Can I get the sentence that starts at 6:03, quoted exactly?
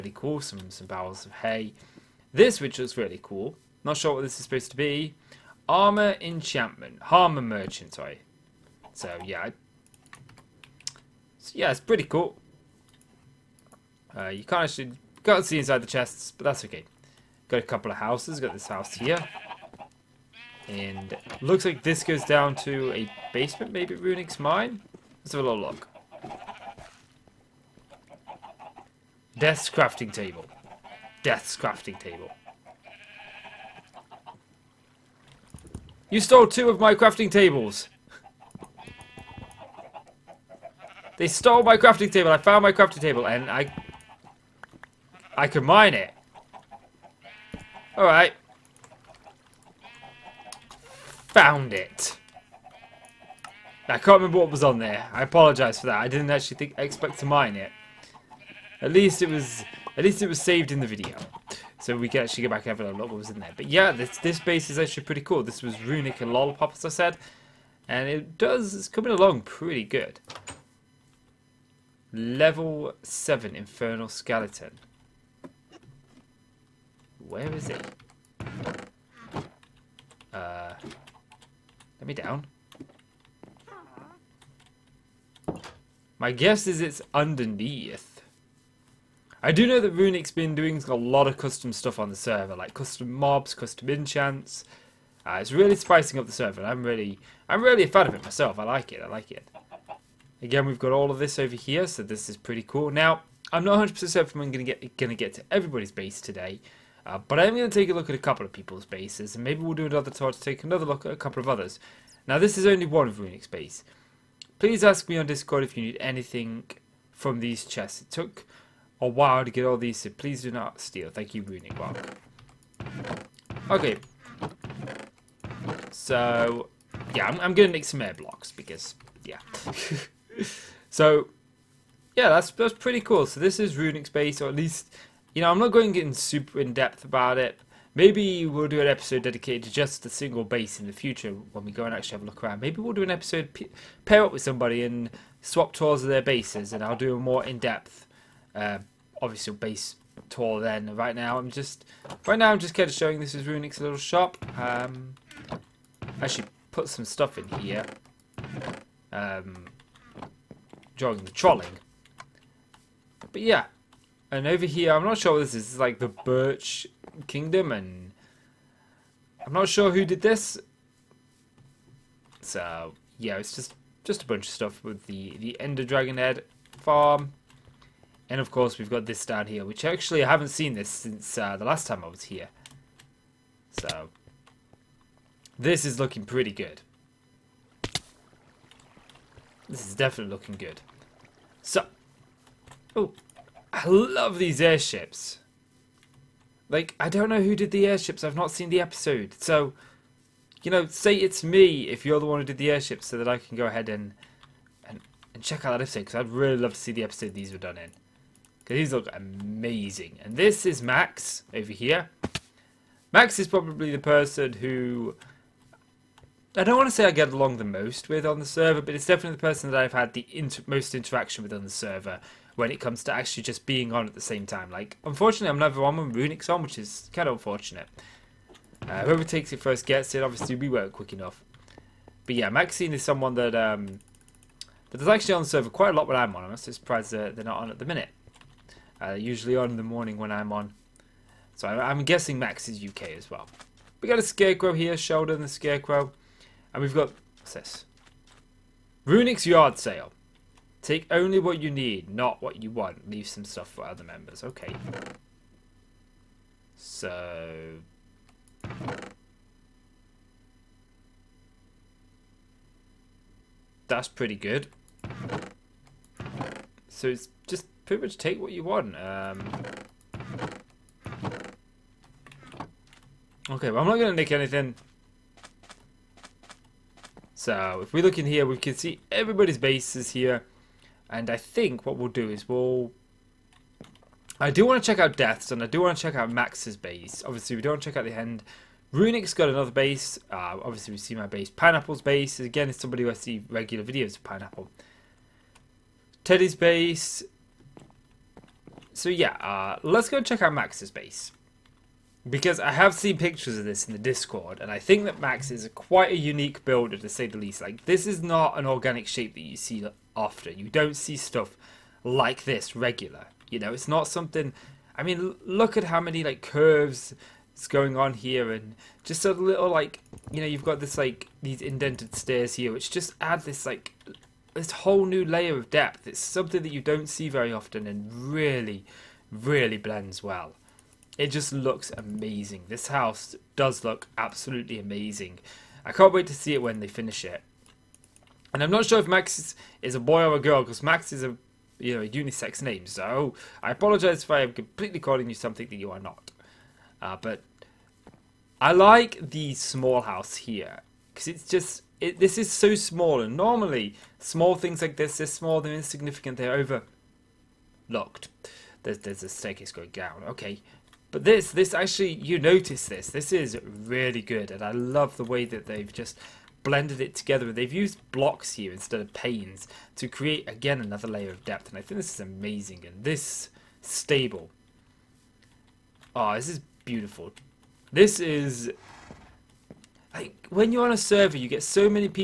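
This is really good, and I love the way that they've just blended it together.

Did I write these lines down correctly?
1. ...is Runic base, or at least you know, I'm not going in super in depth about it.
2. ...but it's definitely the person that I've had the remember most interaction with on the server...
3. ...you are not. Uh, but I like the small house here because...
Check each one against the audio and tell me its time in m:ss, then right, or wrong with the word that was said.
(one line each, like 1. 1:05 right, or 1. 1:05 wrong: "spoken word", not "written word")
1. 2:13 right
2. 3:38 wrong: "inter", not "remember"
3. 5:45 right.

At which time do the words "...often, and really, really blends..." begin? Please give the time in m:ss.
5:27.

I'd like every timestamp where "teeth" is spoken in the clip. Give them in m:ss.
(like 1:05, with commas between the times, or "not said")
not said.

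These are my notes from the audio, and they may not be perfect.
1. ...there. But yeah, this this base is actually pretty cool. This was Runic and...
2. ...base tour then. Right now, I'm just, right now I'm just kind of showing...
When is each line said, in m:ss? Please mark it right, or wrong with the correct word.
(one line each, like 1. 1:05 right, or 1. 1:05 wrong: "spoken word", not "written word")
1. 1:03 right
2. 2:29 right.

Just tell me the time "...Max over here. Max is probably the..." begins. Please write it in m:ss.
3:30.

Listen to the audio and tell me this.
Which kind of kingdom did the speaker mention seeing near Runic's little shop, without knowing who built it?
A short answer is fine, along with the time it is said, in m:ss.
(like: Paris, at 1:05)
Birch Kingdom, at 2:46.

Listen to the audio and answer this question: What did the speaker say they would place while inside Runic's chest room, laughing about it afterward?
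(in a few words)
air blocks.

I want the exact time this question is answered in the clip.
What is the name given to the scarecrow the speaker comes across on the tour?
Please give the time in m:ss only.
4:04.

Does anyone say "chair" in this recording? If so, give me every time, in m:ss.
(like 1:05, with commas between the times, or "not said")
not said.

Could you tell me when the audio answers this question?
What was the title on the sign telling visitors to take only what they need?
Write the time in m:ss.
4:09.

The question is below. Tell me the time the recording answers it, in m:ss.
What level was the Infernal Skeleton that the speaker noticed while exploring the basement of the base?
1:12.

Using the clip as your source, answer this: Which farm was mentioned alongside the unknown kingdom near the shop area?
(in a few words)
Ender Dragon Head farm.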